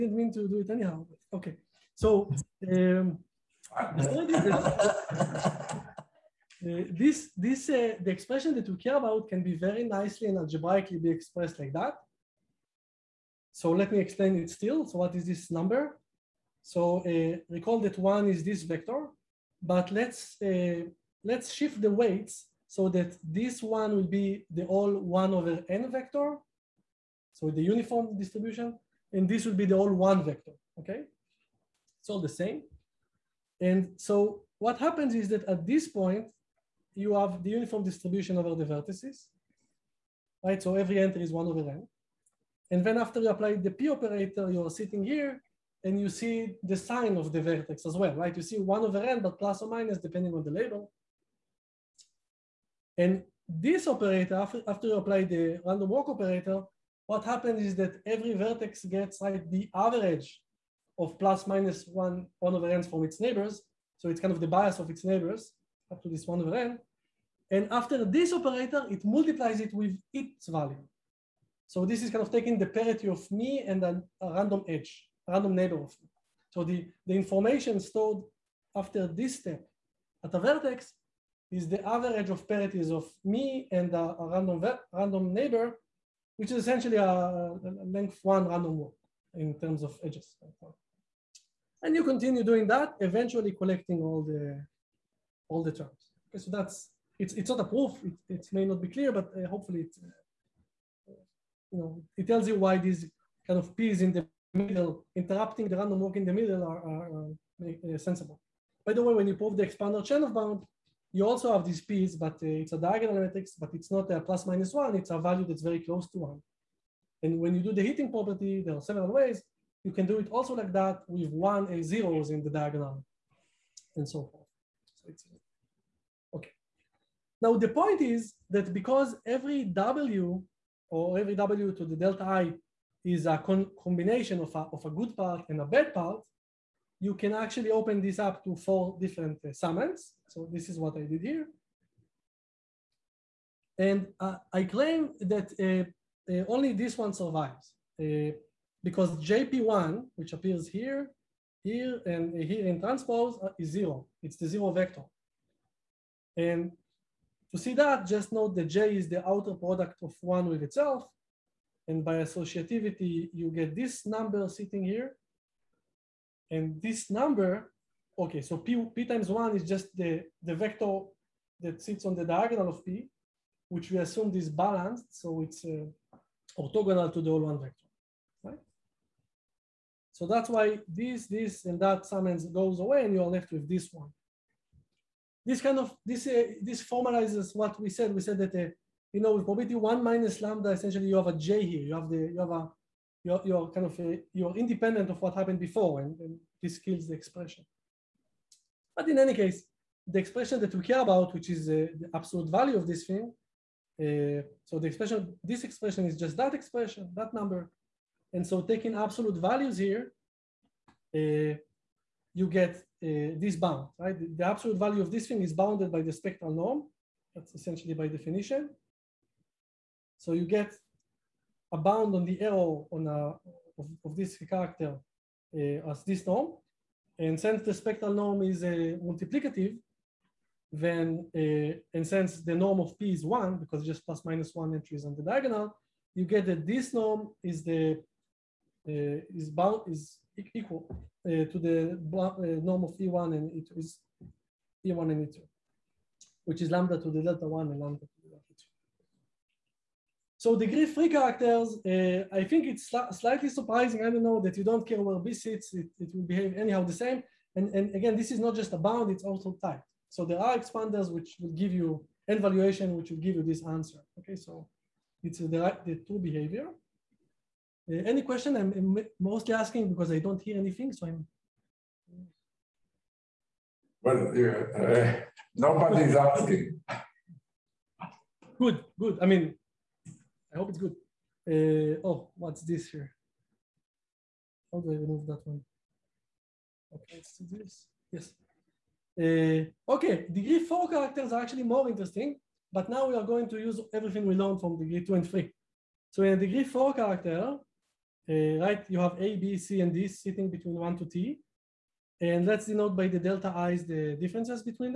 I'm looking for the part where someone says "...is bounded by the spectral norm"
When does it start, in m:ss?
3:35.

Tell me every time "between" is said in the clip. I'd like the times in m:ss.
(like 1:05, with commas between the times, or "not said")
5:00.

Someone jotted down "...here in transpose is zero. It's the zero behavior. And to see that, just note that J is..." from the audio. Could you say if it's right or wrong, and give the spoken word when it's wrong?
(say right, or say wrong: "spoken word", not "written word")
wrong: "vector", not "behavior".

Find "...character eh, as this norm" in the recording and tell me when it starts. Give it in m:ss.
3:44.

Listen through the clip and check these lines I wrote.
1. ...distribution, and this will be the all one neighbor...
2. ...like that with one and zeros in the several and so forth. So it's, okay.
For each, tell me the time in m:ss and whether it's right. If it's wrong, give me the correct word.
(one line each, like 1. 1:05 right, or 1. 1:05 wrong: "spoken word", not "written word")
1. 0:28 wrong: "vector", not "neighbor"
2. 2:00 wrong: "diagonal", not "several".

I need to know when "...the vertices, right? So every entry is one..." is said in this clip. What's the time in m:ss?
0:38.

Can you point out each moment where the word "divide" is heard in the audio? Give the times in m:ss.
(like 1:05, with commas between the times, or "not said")
not said.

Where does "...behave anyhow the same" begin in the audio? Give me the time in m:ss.
4:16.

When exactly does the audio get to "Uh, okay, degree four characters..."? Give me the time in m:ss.
4:49.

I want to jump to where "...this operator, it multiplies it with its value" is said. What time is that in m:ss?
1:08.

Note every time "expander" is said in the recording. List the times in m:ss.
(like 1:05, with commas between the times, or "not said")
1:49, 4:20.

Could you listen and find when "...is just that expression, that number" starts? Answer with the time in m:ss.
3:26.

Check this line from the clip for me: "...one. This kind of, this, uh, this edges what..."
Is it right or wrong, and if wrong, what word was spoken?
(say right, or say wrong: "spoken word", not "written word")
wrong: "formalizes", not "edges".